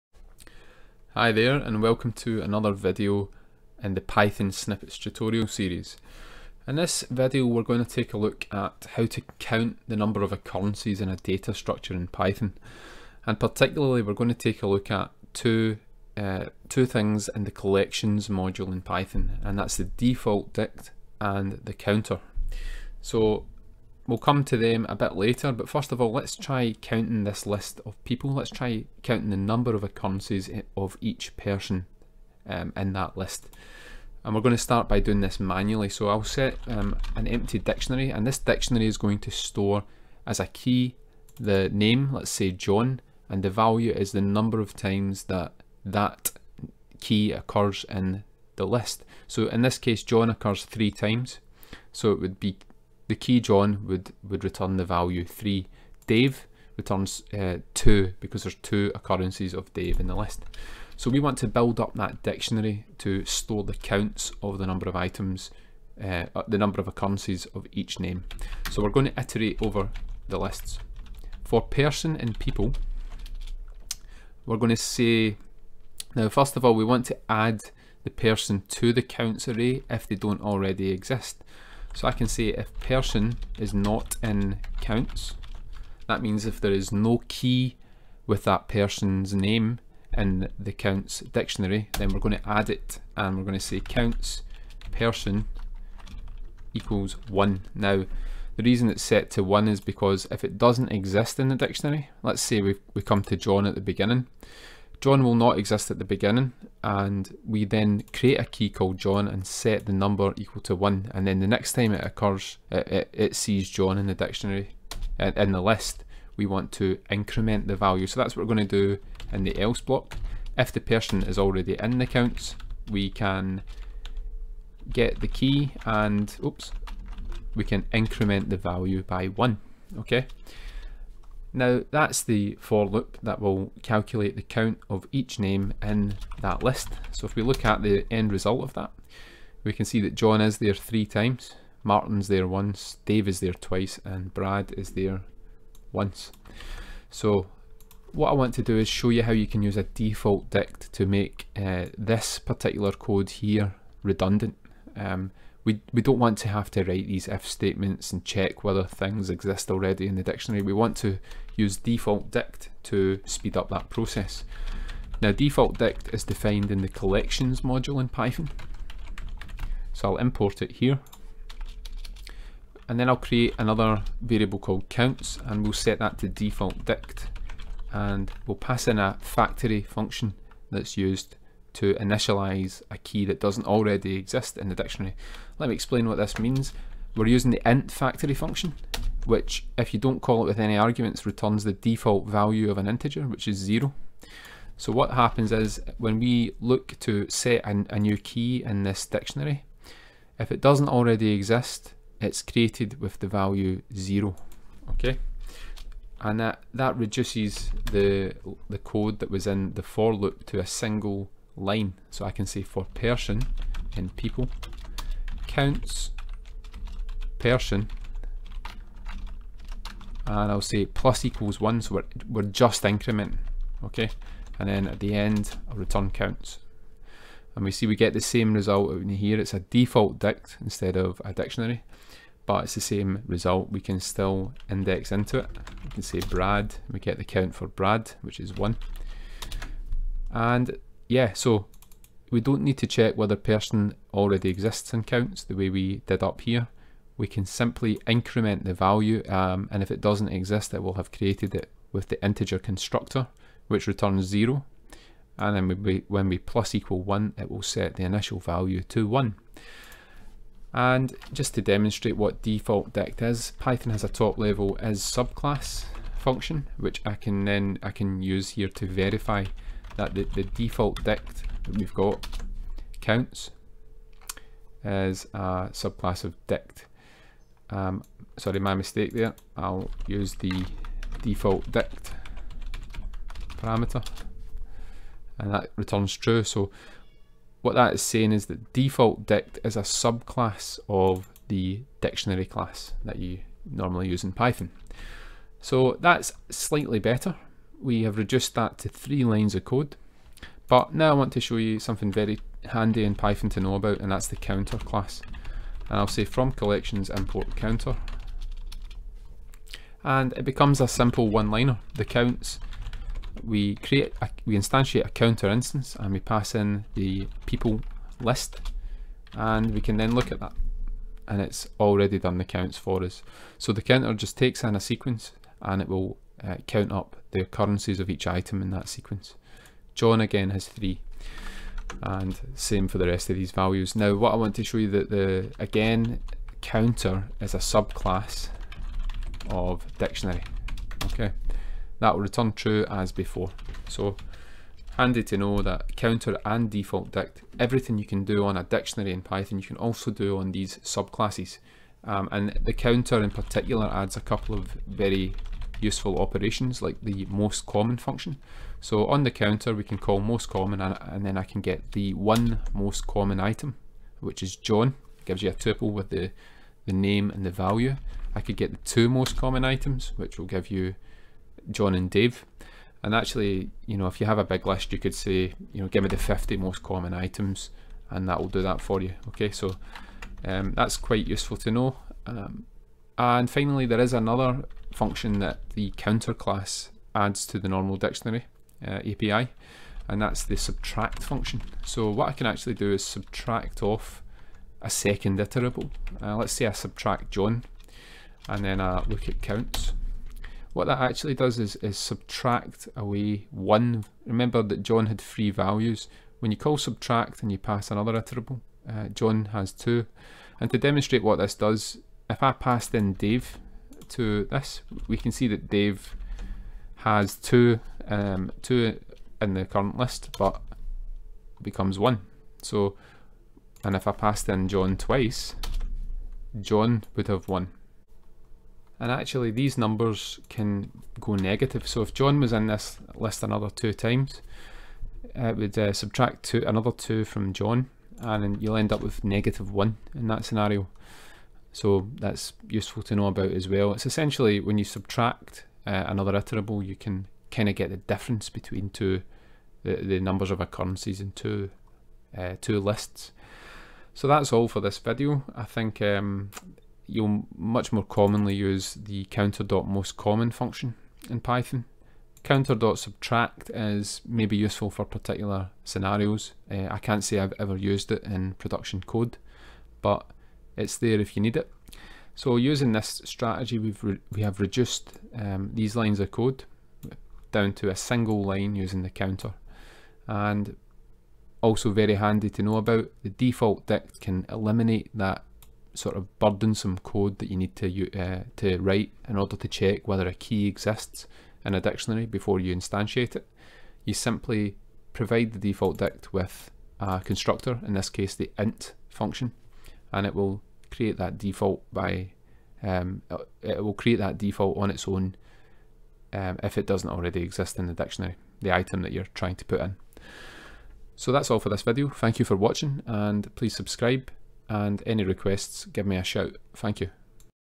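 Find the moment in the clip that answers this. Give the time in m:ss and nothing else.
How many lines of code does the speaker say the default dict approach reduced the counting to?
4:58.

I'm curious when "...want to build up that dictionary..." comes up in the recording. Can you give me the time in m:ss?
1:01.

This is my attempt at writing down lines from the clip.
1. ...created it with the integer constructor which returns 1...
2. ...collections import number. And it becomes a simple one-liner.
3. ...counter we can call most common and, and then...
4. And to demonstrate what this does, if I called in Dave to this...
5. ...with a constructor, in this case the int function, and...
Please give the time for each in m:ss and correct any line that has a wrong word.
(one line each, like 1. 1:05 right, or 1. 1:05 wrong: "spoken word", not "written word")
1. 4:11 wrong: "0", not "1"
2. 5:06 wrong: "counter", not "number"
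3. 5:59 right
4. 6:50 wrong: "passed", not "called"
5. 8:16 right.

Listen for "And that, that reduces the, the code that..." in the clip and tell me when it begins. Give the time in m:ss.
3:26.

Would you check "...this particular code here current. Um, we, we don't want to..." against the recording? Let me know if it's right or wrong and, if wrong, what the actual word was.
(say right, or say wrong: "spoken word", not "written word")
wrong: "redundant", not "current".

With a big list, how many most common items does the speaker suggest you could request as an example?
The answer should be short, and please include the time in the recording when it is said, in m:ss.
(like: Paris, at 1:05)
50, at 6:16.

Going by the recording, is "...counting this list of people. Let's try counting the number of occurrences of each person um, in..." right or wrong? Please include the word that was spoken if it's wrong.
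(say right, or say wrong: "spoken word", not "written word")
right.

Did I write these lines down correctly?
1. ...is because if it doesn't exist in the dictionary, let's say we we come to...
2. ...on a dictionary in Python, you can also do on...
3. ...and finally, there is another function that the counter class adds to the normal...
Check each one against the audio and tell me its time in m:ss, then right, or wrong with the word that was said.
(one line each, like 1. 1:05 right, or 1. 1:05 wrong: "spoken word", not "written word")
1. 1:39 right
2. 5:48 right
3. 6:23 right.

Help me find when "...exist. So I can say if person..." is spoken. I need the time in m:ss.
1:20.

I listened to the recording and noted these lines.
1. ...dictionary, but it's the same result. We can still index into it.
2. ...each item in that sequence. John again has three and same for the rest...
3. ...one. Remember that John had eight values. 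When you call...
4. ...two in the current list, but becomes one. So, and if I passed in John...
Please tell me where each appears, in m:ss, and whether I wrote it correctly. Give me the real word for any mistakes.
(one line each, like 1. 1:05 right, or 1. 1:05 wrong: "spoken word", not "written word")
1. 3:51 right
2. 5:28 right
3. 6:43 wrong: "three", not "eight"
4. 6:58 right.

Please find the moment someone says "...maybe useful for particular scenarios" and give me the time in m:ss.
7:44.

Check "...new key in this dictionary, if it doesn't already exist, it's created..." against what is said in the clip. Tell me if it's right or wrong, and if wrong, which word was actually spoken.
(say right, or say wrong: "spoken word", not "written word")
right.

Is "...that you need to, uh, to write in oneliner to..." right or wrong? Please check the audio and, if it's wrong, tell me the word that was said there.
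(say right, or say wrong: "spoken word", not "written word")
wrong: "order", not "oneliner".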